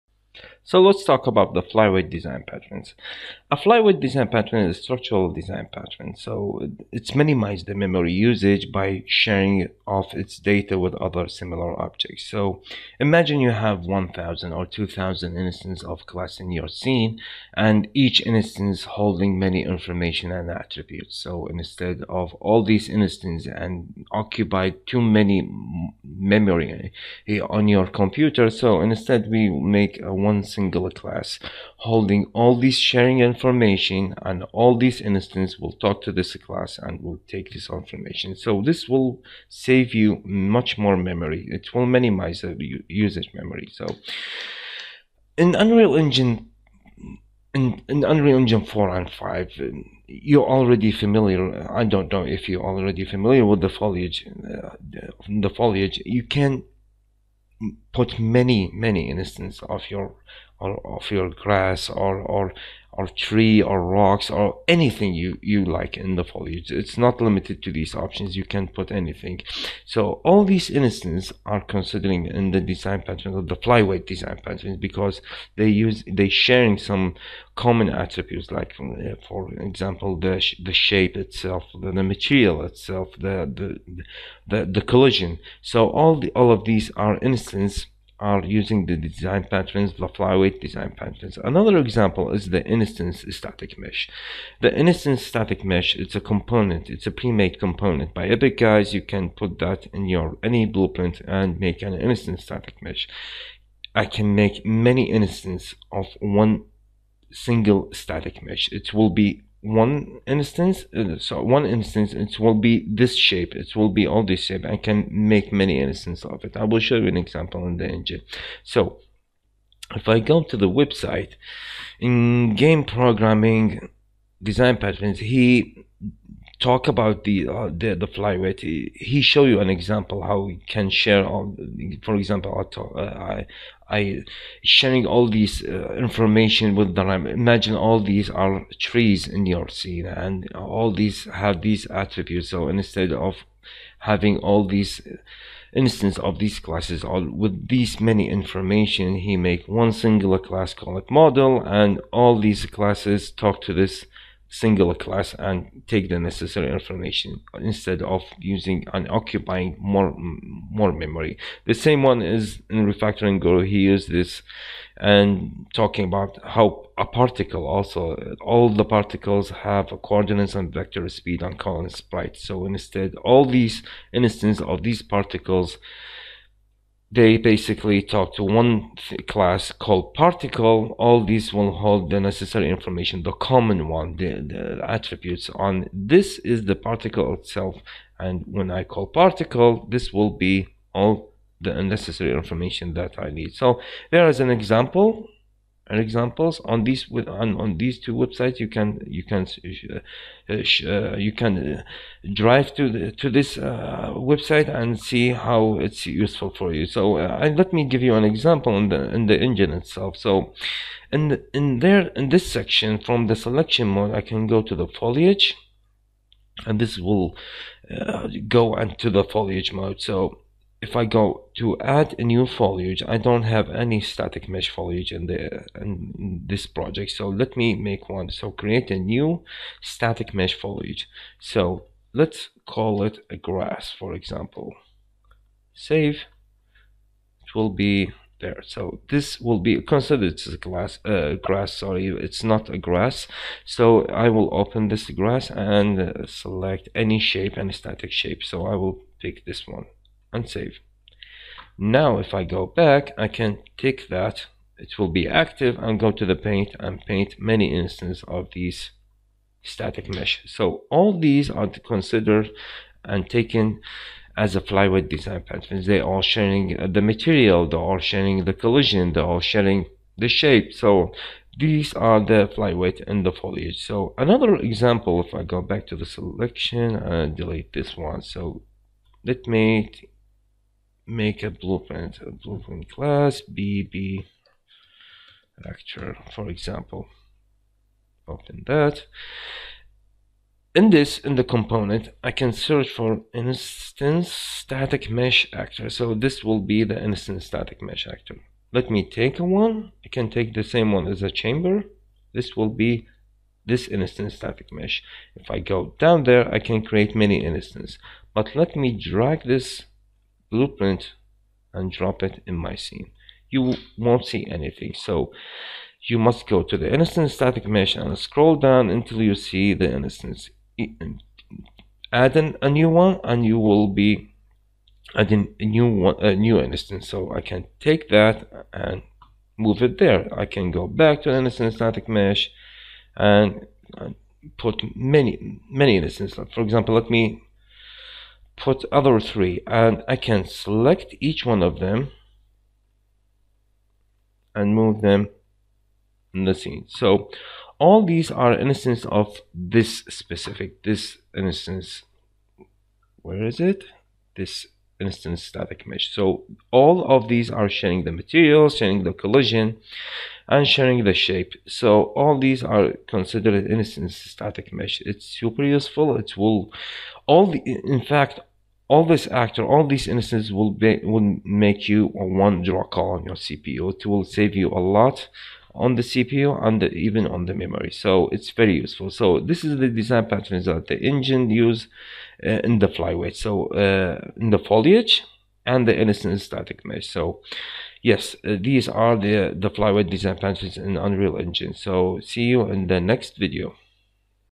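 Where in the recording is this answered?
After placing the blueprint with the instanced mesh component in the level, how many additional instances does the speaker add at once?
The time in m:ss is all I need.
5:39.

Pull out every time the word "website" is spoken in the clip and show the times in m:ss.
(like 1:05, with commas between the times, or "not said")
2:00, 3:18, 3:24.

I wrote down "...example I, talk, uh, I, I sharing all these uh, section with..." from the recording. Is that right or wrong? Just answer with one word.
wrong.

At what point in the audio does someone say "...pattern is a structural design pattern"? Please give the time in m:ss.
0:04.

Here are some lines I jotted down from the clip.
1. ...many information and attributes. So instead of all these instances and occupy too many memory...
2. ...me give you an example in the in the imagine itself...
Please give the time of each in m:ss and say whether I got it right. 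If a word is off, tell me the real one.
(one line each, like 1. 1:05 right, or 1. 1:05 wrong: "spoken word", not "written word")
1. 0:19 right
2. 3:27 wrong: "engine", not "imagine".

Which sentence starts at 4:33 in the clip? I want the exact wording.
So another example, if I go back to the selection and delete this one.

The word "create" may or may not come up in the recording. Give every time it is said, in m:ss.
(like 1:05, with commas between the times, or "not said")
3:48, 5:06.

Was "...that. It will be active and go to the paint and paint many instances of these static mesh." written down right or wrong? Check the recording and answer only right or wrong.
right.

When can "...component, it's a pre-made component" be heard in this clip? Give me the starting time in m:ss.
1:36.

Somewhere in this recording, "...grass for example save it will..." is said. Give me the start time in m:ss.
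3:53.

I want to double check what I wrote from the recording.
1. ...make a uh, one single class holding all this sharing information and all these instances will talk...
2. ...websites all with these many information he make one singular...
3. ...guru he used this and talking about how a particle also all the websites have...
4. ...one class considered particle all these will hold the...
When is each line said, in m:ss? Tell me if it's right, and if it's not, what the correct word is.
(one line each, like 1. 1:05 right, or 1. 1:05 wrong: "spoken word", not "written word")
1. 0:29 right
2. 2:26 wrong: "classes", not "websites"
3. 2:43 wrong: "particles", not "websites"
4. 2:58 wrong: "called", not "considered".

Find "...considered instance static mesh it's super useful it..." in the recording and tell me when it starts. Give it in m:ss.
6:03.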